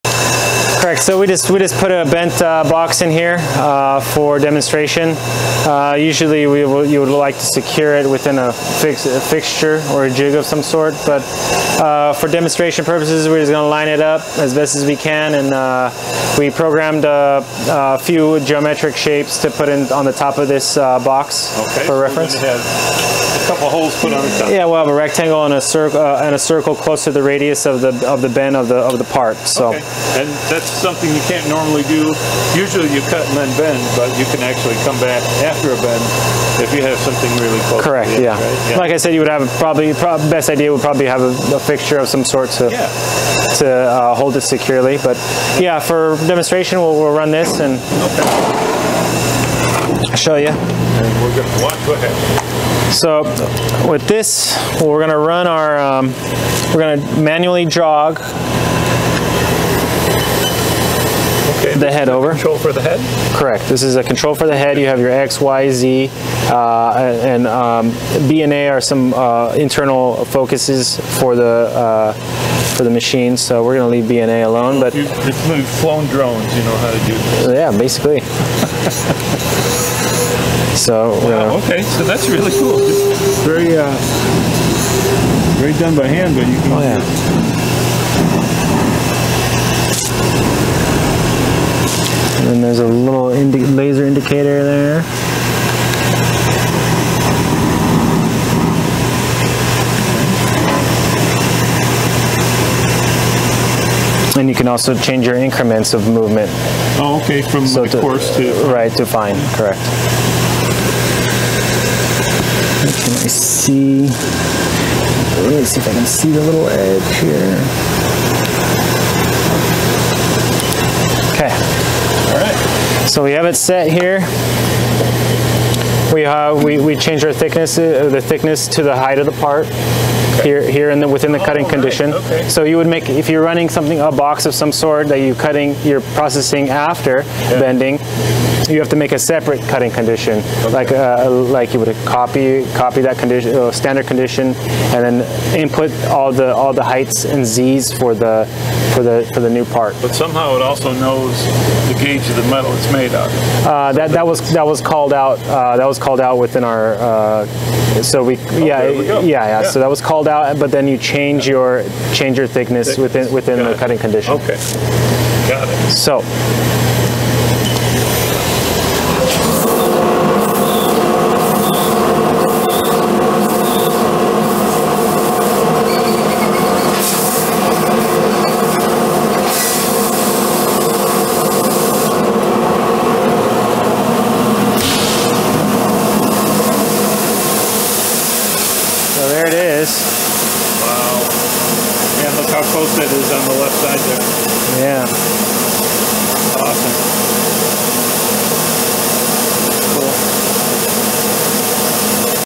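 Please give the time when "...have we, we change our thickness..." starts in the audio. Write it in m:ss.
2:06.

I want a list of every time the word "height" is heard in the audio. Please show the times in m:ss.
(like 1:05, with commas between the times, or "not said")
2:08, 2:26.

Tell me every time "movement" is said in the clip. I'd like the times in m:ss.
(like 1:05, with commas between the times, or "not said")
1:46.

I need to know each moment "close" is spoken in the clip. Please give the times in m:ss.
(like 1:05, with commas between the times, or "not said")
0:26, 0:37, 3:12.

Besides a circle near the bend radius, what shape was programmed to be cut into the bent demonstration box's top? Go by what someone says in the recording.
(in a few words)
Rectangle.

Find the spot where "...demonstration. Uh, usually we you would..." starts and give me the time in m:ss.
0:04.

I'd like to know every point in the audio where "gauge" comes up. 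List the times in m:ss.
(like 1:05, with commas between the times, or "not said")
2:31.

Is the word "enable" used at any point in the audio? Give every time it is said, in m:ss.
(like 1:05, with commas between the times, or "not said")
not said.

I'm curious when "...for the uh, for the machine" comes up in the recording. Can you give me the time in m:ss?
1:11.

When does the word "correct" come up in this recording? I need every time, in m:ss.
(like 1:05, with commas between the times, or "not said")
0:00, 0:37, 1:03, 1:49.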